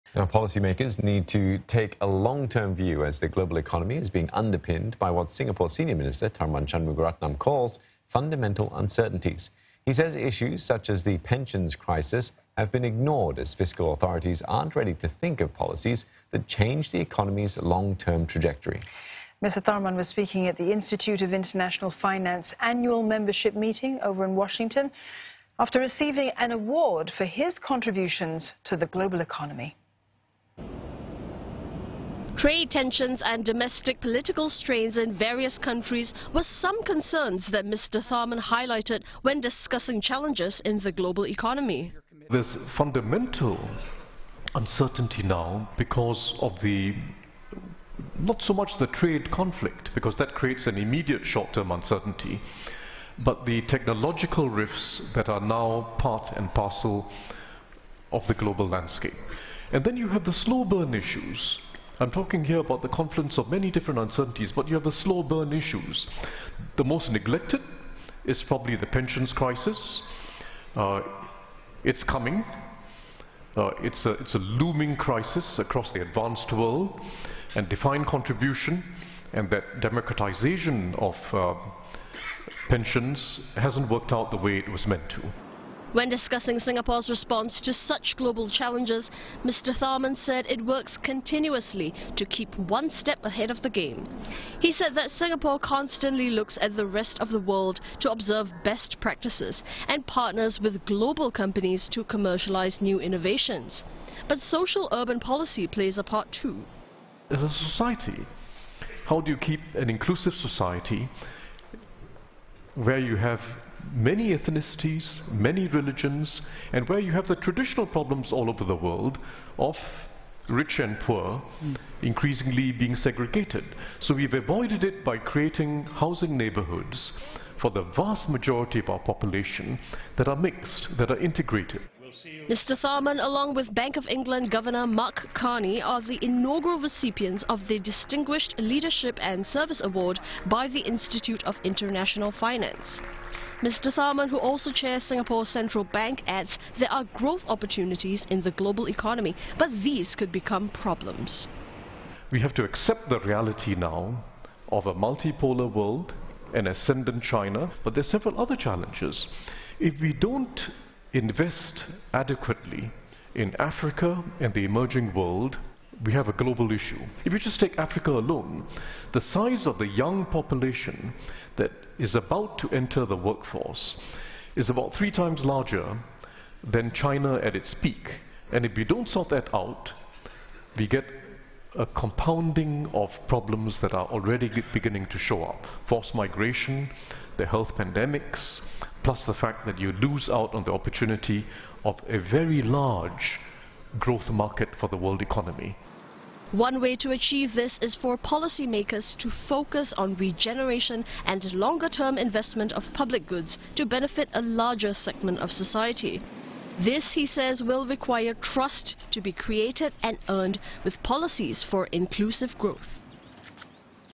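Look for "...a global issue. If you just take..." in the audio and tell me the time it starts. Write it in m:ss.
2:46.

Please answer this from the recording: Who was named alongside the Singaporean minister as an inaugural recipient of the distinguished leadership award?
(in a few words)
Mark Carney.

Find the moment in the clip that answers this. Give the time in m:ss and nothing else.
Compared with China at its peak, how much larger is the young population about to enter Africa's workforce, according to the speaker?
2:54.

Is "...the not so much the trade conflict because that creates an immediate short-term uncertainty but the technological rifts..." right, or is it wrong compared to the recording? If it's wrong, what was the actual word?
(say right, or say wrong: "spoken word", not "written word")
right.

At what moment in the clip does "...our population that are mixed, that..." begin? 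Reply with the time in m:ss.
2:08.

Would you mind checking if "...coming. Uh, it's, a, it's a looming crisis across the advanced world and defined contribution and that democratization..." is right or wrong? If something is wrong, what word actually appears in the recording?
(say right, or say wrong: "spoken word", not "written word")
right.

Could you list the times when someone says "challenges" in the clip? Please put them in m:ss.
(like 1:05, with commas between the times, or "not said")
0:40, 1:28, 2:38.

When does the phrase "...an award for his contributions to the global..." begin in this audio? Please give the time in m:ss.
0:26.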